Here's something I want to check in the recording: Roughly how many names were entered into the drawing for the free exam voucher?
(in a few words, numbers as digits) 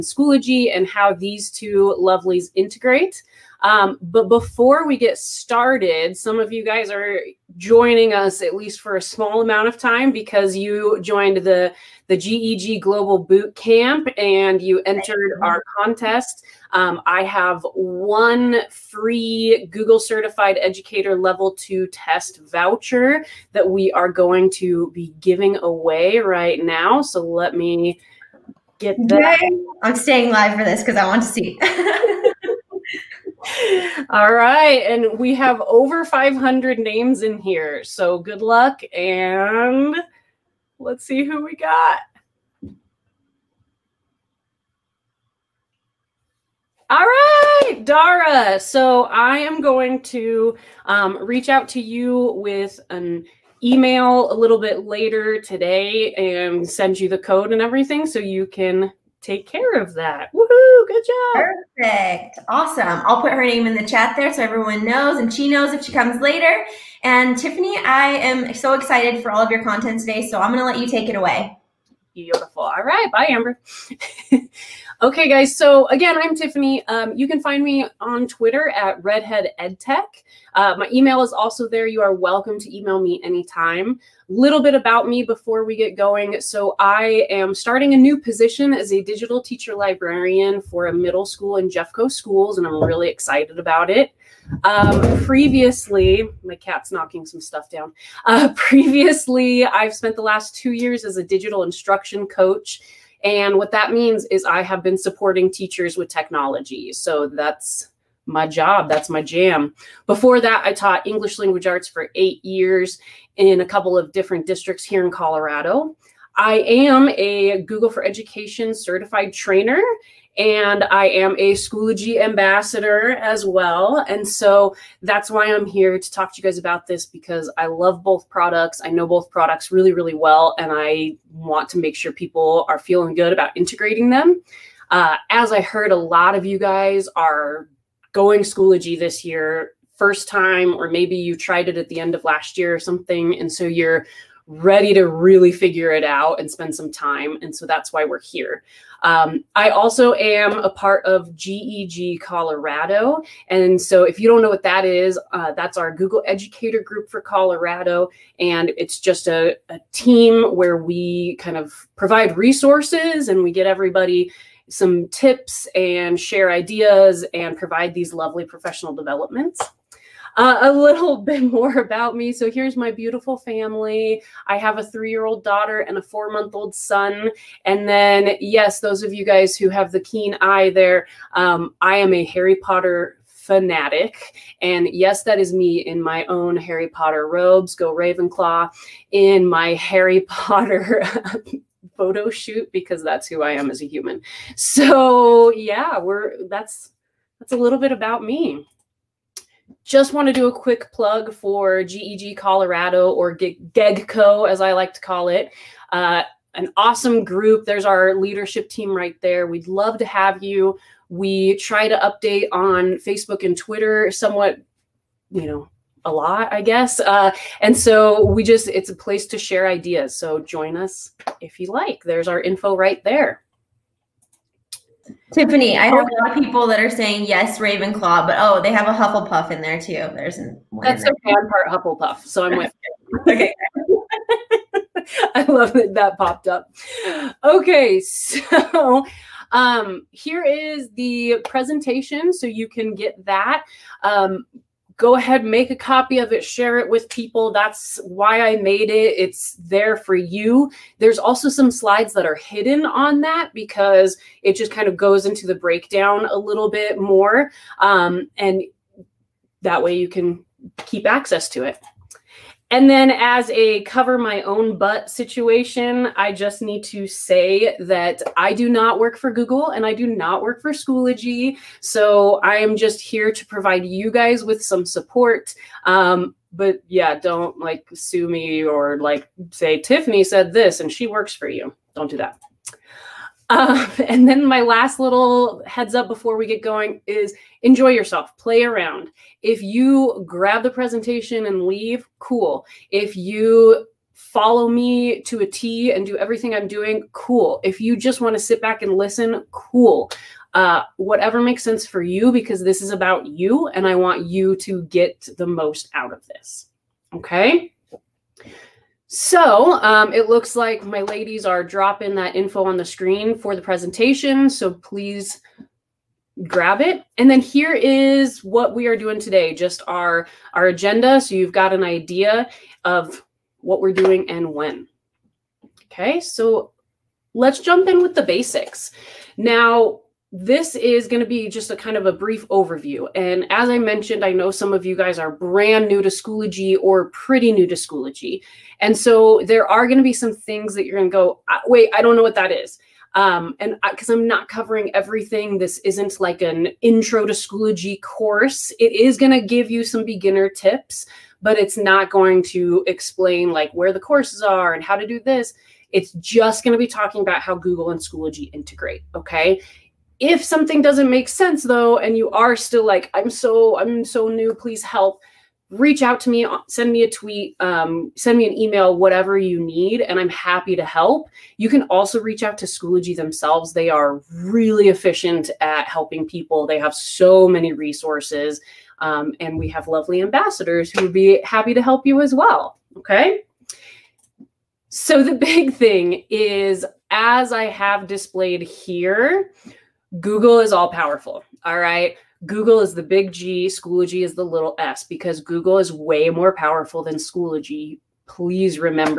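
500.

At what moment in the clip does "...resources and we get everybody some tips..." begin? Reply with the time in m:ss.
2:42.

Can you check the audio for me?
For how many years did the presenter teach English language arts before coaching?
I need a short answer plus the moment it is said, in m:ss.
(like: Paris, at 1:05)
8, at 1:52.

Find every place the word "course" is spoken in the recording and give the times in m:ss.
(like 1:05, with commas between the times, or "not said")
5:48, 5:53.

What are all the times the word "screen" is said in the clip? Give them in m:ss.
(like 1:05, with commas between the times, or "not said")
5:12.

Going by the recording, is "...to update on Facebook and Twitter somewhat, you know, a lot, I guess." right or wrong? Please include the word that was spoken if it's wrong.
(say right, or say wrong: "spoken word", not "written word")
right.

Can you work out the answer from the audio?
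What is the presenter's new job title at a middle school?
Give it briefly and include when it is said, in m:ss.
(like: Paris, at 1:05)
digital teacher librarian, at 1:29.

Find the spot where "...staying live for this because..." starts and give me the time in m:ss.
0:29.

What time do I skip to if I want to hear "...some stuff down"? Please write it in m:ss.
1:37.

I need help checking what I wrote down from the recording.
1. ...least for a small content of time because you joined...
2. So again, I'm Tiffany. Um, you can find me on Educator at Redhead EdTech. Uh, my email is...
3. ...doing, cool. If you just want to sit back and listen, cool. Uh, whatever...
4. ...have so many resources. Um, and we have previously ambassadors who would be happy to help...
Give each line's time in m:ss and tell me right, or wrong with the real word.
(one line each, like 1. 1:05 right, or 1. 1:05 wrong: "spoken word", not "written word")
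1. 0:08 wrong: "amount", not "content"
2. 1:15 wrong: "Twitter", not "Educator"
3. 4:56 right
4. 6:16 wrong: "lovely", not "previously".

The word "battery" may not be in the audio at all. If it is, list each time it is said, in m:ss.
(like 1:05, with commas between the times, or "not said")
not said.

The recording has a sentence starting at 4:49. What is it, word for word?
If you grab the presentation and leave, cool.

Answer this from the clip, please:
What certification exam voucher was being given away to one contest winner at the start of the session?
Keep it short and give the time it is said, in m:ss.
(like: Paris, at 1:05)
Google Certified Educator Level 2, at 0:19.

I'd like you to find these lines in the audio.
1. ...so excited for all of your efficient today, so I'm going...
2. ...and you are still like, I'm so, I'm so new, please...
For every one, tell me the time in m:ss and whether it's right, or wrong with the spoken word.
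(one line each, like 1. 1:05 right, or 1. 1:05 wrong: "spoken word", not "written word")
1. 1:08 wrong: "content", not "efficient"
2. 6:01 right.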